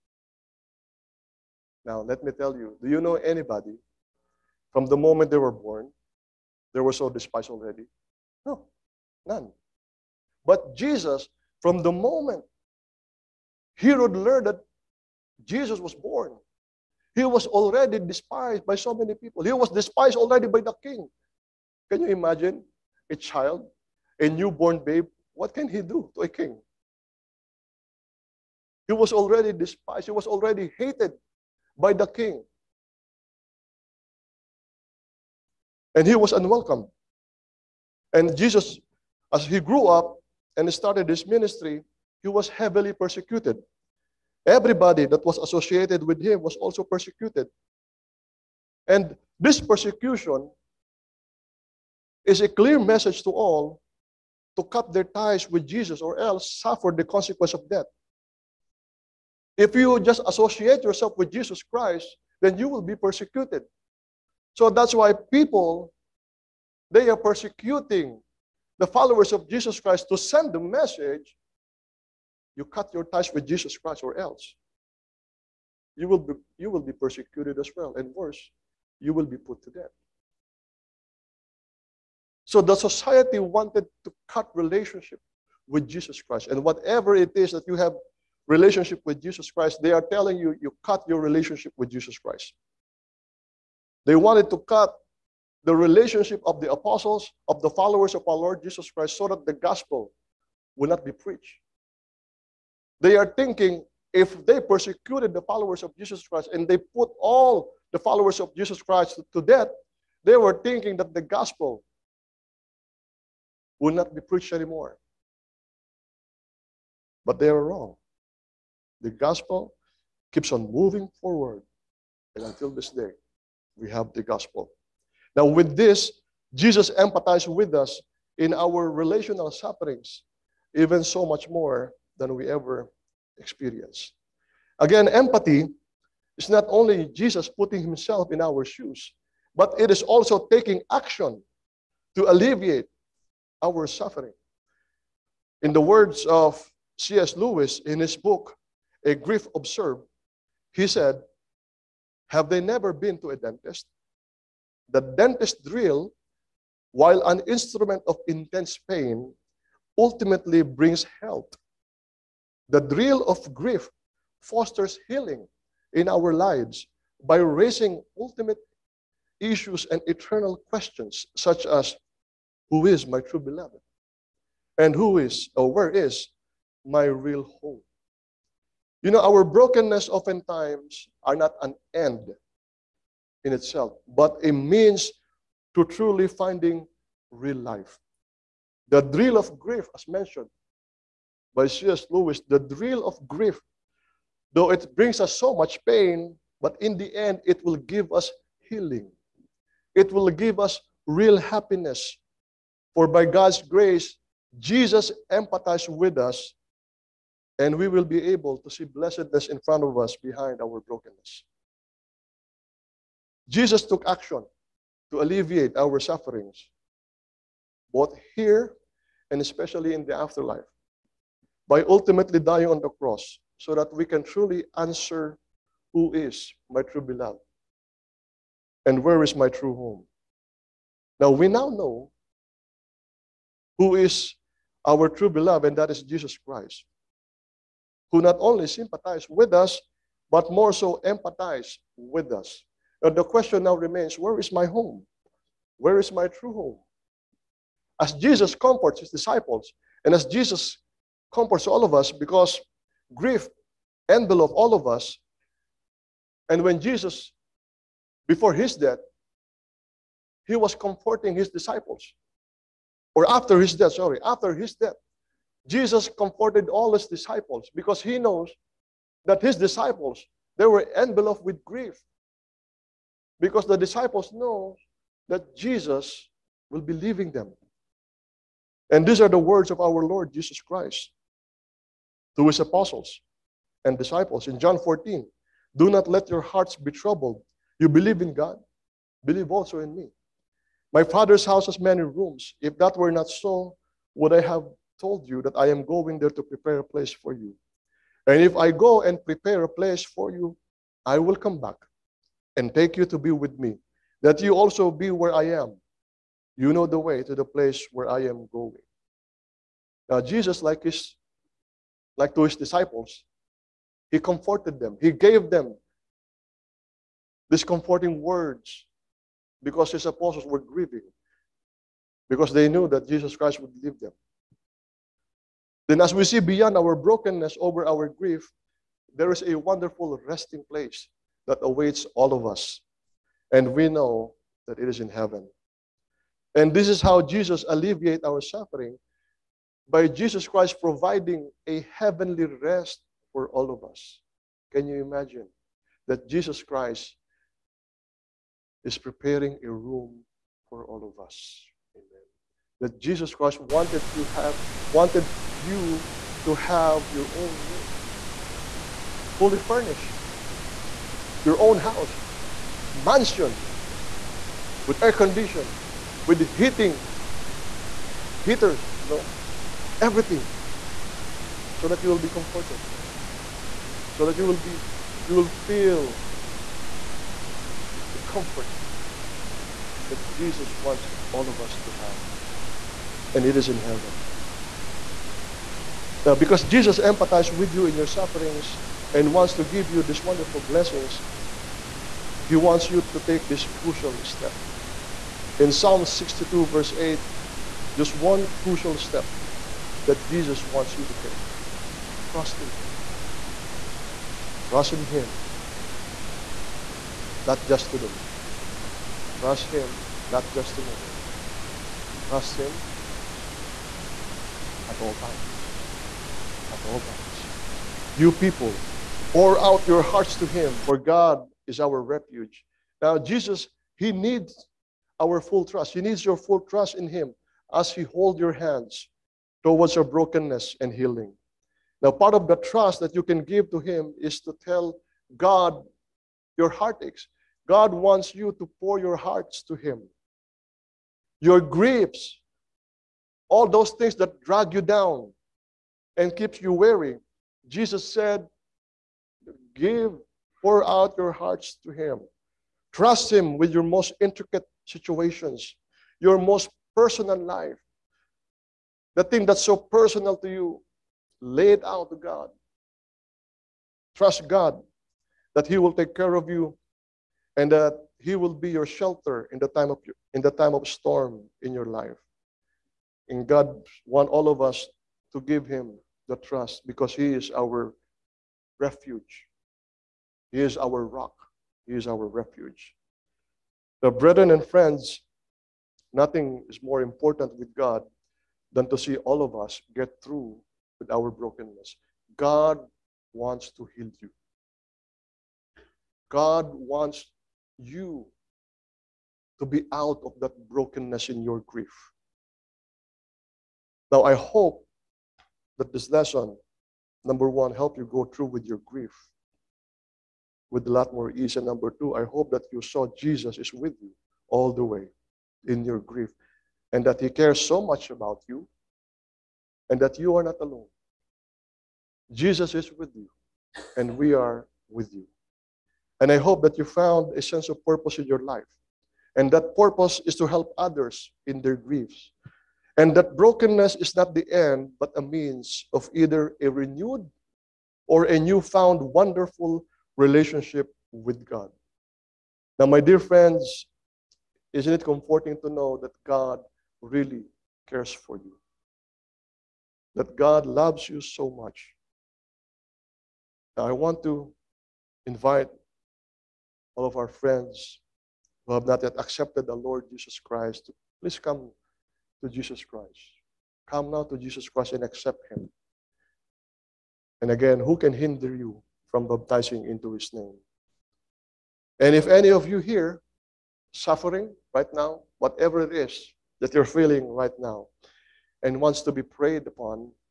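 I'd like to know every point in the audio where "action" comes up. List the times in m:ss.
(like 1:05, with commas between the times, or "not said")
2:20, 3:34.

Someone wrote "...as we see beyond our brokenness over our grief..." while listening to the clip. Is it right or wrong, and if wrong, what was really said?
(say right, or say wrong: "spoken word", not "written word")
right.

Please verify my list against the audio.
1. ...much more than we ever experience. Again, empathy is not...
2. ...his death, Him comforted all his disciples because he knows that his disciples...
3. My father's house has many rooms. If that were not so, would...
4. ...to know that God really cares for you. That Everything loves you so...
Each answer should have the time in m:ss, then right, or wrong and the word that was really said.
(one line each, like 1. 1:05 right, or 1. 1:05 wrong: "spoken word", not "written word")
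1. 2:11 right
2. 4:24 wrong: "Jesus", not "Him"
3. 4:50 right
4. 9:05 wrong: "God", not "Everything".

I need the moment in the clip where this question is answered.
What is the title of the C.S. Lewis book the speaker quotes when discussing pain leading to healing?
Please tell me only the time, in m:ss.
2:29.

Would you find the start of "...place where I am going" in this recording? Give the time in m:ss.
5:07.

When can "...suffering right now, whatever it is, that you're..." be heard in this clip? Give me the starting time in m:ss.
9:33.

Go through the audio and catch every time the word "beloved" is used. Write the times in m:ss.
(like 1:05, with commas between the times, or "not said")
2:53, 3:47, 3:55.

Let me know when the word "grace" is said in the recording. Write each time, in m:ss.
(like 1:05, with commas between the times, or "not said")
3:23.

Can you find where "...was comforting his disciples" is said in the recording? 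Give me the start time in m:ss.
4:20.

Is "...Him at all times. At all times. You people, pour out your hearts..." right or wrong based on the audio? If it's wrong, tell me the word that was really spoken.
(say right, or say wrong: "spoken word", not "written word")
right.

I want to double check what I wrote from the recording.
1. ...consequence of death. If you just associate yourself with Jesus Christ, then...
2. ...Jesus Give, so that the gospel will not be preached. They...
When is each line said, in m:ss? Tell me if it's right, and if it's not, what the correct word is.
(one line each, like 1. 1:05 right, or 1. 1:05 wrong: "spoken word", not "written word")
1. 0:57 right
2. 1:38 wrong: "Christ", not "Give".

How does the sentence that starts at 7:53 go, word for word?
And God wants all of us to give Him the trust because He is our refuge.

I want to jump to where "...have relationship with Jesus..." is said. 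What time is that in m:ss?
1:27.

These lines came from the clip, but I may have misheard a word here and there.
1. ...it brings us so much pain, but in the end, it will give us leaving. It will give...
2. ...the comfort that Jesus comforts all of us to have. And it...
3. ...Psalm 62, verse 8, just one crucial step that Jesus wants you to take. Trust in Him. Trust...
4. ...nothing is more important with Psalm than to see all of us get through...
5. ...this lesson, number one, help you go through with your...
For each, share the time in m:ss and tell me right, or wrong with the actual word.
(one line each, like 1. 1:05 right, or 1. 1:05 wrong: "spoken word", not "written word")
1. 3:14 wrong: "healing", not "leaving"
2. 6:18 wrong: "wants", not "comforts"
3. 6:35 right
4. 8:06 wrong: "God", not "Psalm"
5. 8:25 right.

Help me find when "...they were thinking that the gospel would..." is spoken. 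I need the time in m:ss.
1:50.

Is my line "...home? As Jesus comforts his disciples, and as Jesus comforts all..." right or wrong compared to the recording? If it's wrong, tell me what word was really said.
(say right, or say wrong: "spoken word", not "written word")
right.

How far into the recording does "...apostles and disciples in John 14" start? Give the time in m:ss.
4:42.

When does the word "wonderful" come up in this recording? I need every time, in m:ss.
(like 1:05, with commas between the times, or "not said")
5:29, 6:30, 8:58.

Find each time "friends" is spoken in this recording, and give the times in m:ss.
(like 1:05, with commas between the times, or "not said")
8:04, 9:03, 9:17.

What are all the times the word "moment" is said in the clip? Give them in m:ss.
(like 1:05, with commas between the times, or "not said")
0:04, 0:11.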